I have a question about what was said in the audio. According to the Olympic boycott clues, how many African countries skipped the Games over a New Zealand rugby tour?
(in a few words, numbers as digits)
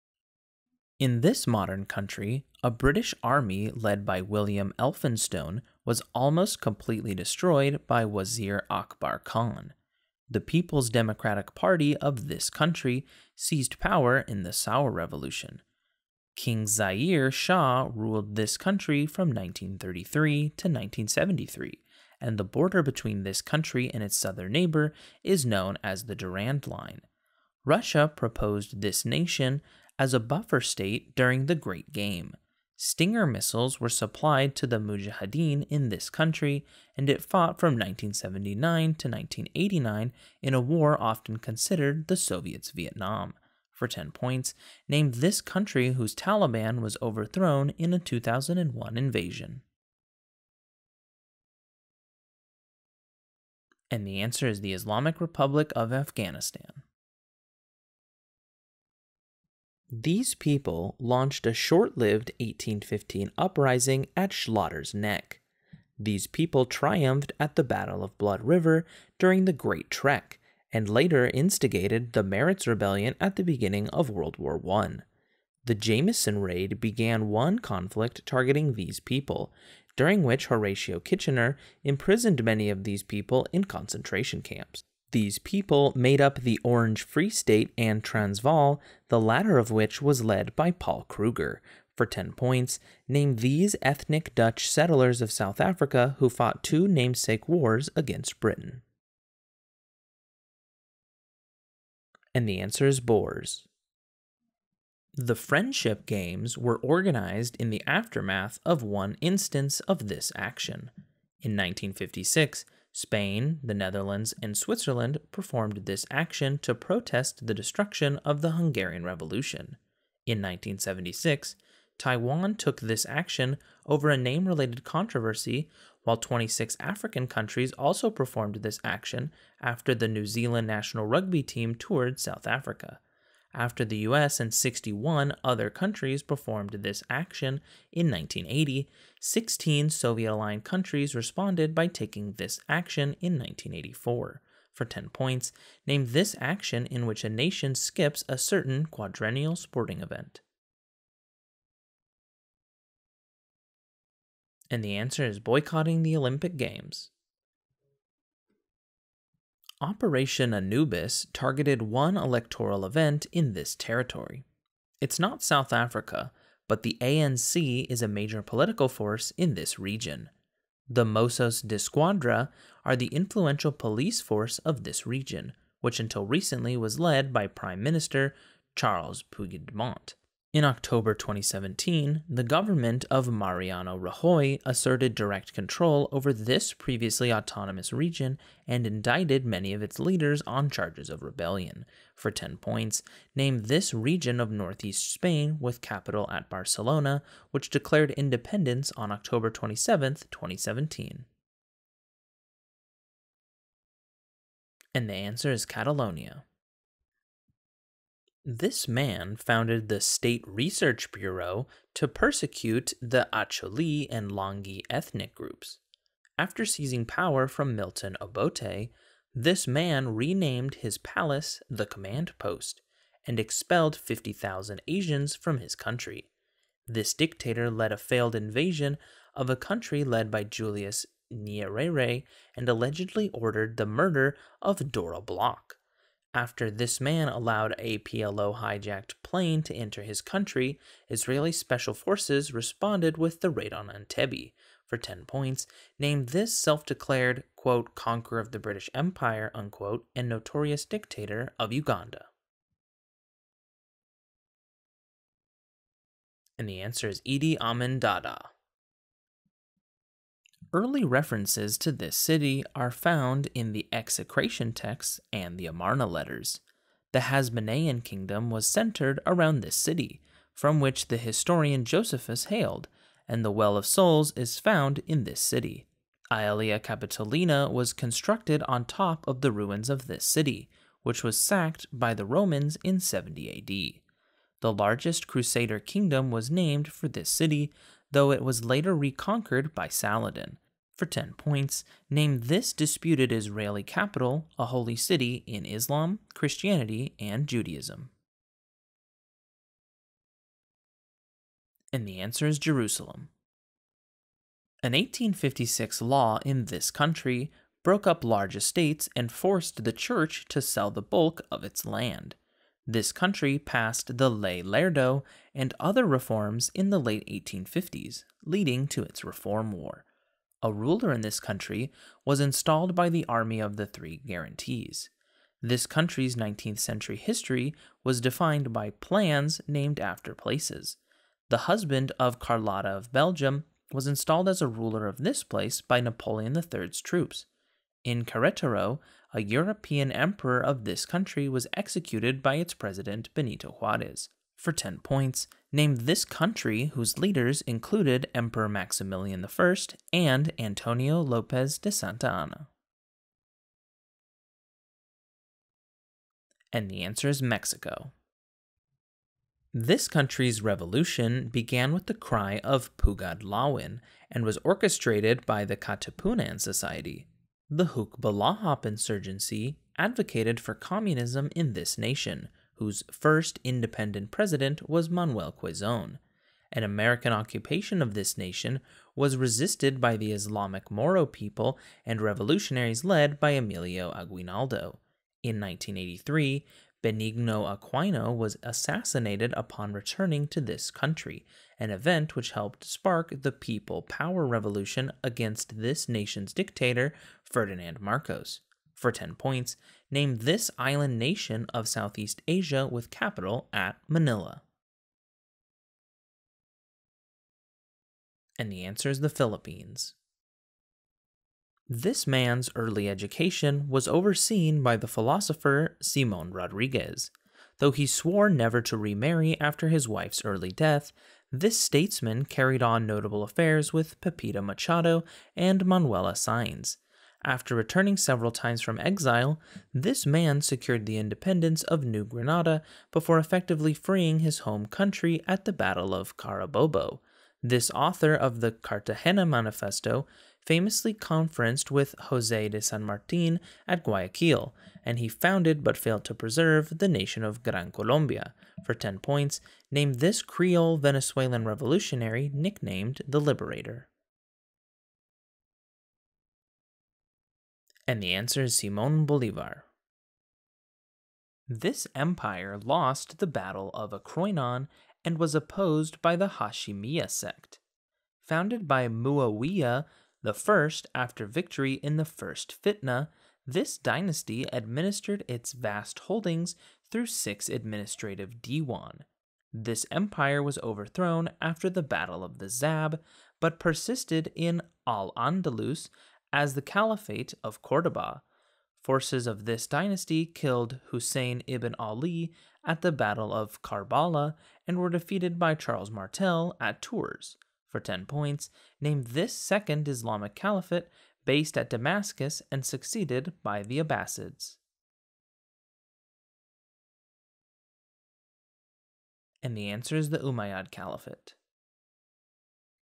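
26.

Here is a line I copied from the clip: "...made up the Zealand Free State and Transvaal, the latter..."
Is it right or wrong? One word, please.
wrong.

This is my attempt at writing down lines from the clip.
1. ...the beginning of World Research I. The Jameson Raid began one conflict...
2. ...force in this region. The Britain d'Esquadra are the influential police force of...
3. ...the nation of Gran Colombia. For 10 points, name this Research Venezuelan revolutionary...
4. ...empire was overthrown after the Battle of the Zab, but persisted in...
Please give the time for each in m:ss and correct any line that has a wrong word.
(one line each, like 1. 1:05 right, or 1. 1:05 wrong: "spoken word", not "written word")
1. 1:13 wrong: "War", not "Research"
2. 2:48 wrong: "Mossos", not "Britain"
3. 7:26 wrong: "Creole", not "Research"
4. 8:00 right.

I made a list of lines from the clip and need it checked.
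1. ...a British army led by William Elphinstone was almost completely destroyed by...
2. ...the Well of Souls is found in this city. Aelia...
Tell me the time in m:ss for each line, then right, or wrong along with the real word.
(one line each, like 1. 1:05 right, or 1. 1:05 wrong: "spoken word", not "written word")
1. 0:02 right
2. 4:33 right.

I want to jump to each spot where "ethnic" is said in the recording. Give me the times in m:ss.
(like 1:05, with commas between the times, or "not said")
1:33, 3:34.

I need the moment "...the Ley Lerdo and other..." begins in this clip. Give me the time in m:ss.
5:14.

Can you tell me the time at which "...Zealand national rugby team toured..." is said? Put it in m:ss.
2:10.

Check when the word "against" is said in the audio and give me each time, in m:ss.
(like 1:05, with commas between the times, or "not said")
1:37, 6:35.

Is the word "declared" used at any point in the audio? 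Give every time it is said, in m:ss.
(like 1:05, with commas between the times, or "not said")
3:17, 4:06.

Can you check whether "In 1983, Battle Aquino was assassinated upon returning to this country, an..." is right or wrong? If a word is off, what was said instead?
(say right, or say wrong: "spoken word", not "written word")
wrong: "Benigno", not "Battle".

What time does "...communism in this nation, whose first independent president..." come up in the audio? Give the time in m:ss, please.
6:10.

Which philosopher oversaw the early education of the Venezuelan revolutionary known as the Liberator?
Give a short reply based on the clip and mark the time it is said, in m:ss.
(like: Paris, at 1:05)
Simon Rodriguez, at 6:55.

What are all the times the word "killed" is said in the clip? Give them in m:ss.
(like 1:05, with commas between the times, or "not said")
8:10.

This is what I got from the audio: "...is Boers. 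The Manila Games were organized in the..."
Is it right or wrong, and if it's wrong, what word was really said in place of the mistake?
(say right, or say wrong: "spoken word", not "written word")
wrong: "Friendship", not "Manila".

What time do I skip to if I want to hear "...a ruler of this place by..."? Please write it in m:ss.
5:34.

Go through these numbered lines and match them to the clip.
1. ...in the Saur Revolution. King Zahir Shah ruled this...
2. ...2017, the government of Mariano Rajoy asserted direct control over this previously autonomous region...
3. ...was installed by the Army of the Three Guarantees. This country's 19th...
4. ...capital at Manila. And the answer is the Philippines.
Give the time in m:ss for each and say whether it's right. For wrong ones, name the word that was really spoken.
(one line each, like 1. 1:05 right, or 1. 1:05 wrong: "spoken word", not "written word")
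1. 0:14 right
2. 3:01 right
3. 5:22 right
4. 6:43 right.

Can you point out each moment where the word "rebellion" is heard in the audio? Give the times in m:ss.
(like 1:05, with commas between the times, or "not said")
1:12, 3:11.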